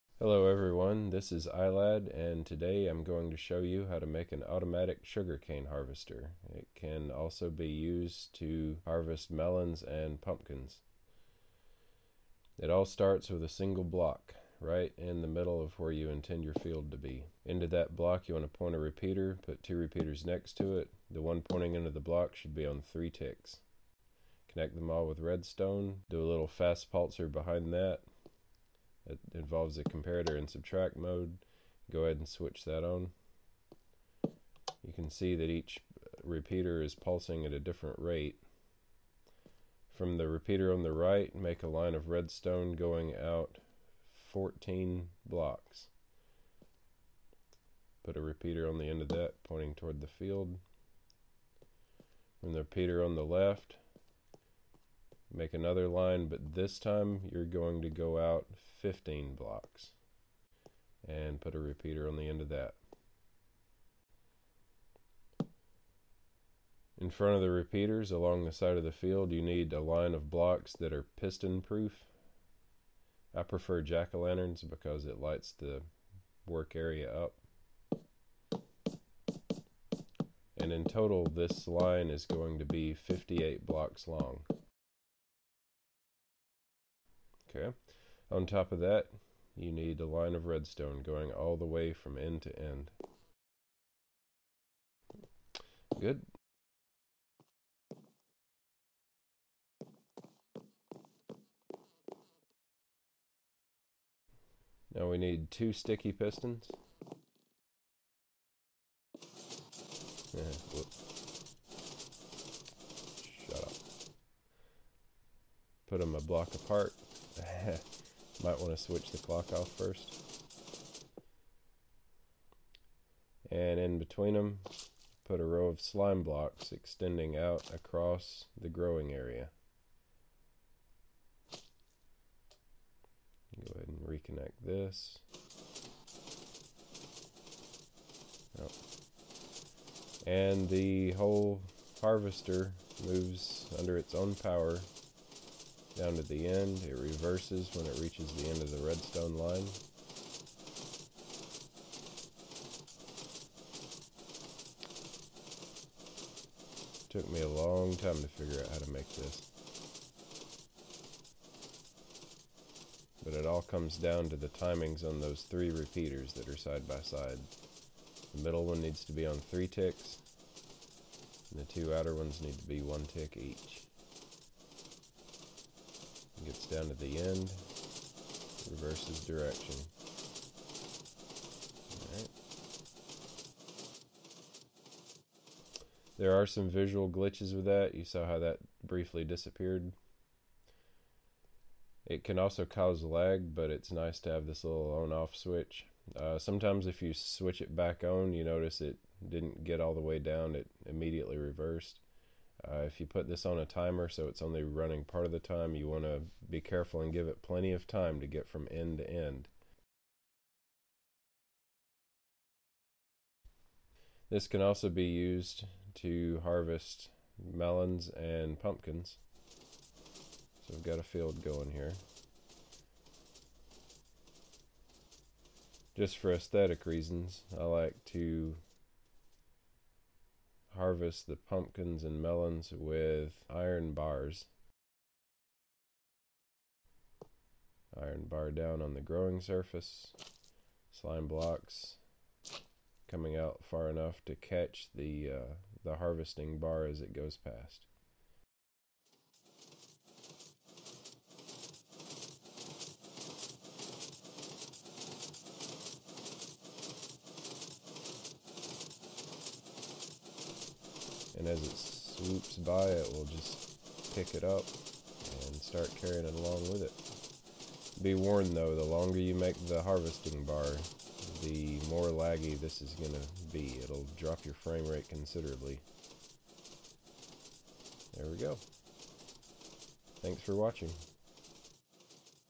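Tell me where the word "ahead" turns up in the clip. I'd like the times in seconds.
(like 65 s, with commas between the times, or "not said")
32 s, 133 s.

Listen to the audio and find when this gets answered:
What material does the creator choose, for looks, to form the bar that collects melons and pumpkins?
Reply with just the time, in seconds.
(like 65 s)
233 s.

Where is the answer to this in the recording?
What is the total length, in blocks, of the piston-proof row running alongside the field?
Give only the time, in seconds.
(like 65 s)
82 s.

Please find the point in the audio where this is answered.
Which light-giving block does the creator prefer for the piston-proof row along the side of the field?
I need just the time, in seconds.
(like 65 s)
73 s.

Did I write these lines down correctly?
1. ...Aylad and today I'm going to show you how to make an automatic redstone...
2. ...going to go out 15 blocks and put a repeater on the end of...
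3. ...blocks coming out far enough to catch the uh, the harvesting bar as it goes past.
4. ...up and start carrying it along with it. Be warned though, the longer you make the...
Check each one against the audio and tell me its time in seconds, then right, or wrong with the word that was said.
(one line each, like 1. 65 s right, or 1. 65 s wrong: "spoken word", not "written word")
1. 1 s wrong: "sugarcane", not "redstone"
2. 57 s right
3. 241 s right
4. 264 s right.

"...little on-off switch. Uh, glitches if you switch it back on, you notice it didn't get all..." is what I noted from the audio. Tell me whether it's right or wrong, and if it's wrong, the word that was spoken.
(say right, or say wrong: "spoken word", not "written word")
wrong: "sometimes", not "glitches".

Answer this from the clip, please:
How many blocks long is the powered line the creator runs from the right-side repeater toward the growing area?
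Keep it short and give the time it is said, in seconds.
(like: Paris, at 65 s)
14, at 44 s.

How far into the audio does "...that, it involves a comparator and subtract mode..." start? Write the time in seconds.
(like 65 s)
27 s.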